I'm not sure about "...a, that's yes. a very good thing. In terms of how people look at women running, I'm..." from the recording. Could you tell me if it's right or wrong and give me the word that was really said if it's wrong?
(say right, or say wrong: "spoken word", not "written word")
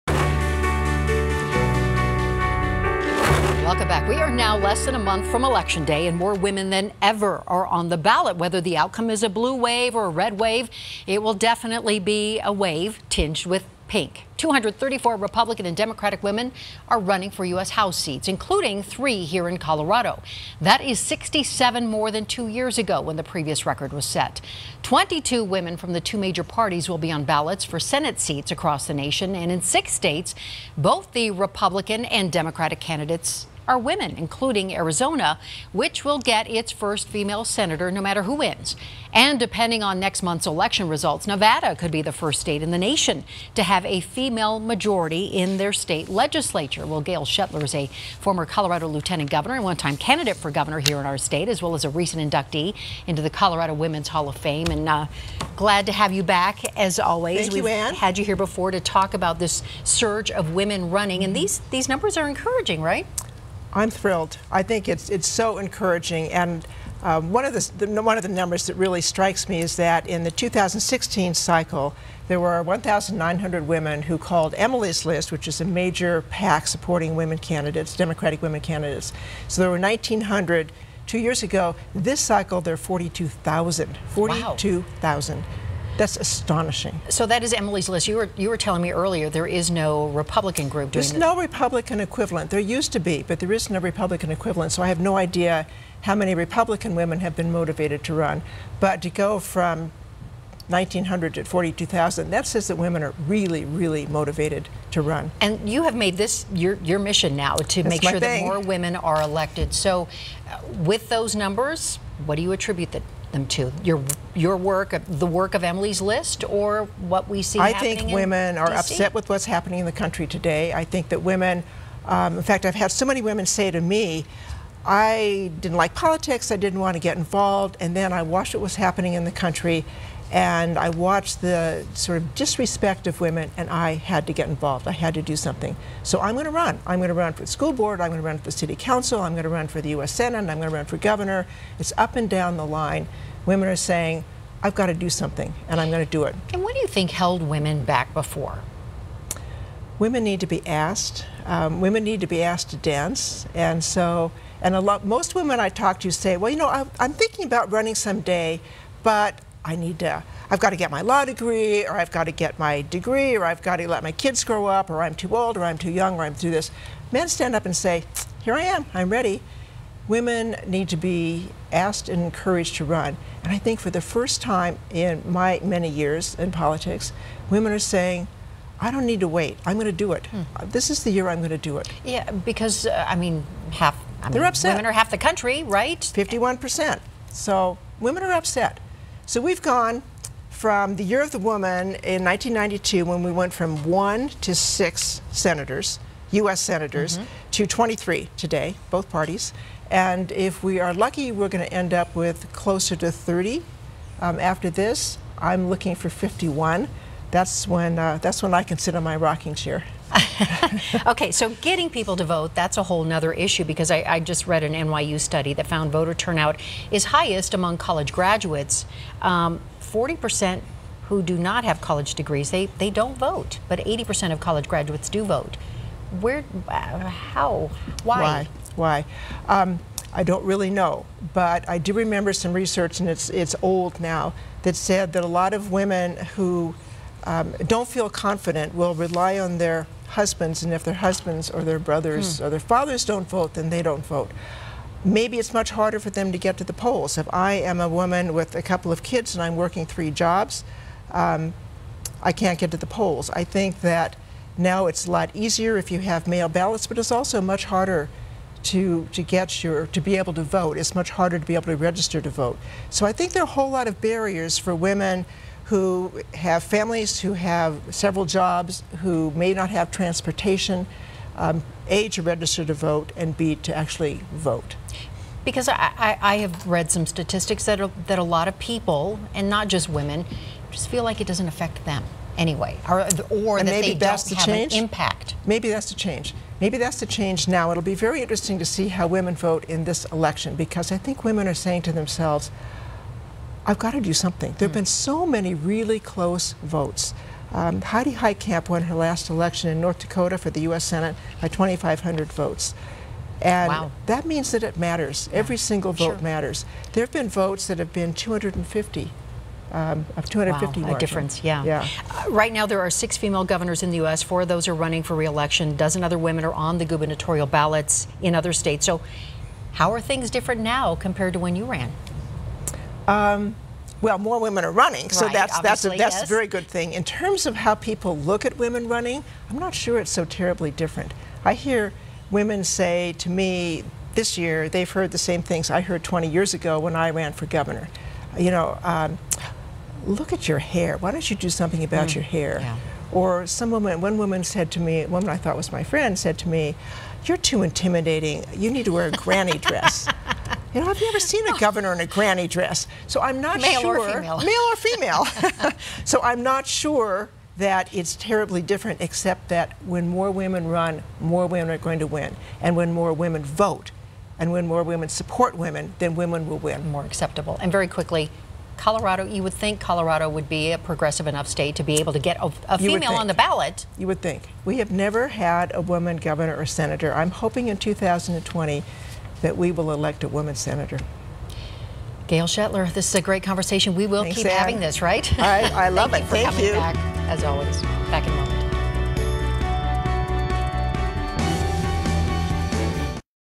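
right.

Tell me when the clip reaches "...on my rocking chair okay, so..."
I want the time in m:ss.
3:28.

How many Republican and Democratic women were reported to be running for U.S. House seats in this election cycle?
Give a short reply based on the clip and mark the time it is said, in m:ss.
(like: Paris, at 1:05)
234, at 0:14.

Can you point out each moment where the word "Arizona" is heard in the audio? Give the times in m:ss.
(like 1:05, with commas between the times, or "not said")
0:34.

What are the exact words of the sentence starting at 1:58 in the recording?
upset with what's happening in the country today.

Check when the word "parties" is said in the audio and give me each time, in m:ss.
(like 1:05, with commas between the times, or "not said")
0:26, 3:19.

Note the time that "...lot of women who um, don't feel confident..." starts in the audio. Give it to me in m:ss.
3:55.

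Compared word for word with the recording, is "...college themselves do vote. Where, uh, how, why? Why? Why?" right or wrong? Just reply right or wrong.
wrong.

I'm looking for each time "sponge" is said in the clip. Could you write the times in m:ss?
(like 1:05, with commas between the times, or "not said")
not said.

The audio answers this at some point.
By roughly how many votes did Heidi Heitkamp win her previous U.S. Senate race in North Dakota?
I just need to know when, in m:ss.
5:01.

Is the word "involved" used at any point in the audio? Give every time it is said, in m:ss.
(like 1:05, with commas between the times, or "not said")
2:07, 2:14.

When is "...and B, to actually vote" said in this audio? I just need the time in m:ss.
4:33.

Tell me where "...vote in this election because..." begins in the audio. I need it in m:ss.
4:49.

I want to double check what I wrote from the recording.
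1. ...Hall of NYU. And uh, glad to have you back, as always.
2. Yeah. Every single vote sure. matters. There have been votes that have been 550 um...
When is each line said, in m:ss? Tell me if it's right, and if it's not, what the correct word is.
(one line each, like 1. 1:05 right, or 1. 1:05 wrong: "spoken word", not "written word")
1. 0:54 wrong: "Fame", not "NYU"
2. 5:05 wrong: "250", not "550".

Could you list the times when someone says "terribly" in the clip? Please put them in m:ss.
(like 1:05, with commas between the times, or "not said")
5:30, 5:58.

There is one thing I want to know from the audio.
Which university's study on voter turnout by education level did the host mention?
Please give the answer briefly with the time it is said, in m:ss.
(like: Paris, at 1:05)
NYU, at 3:34.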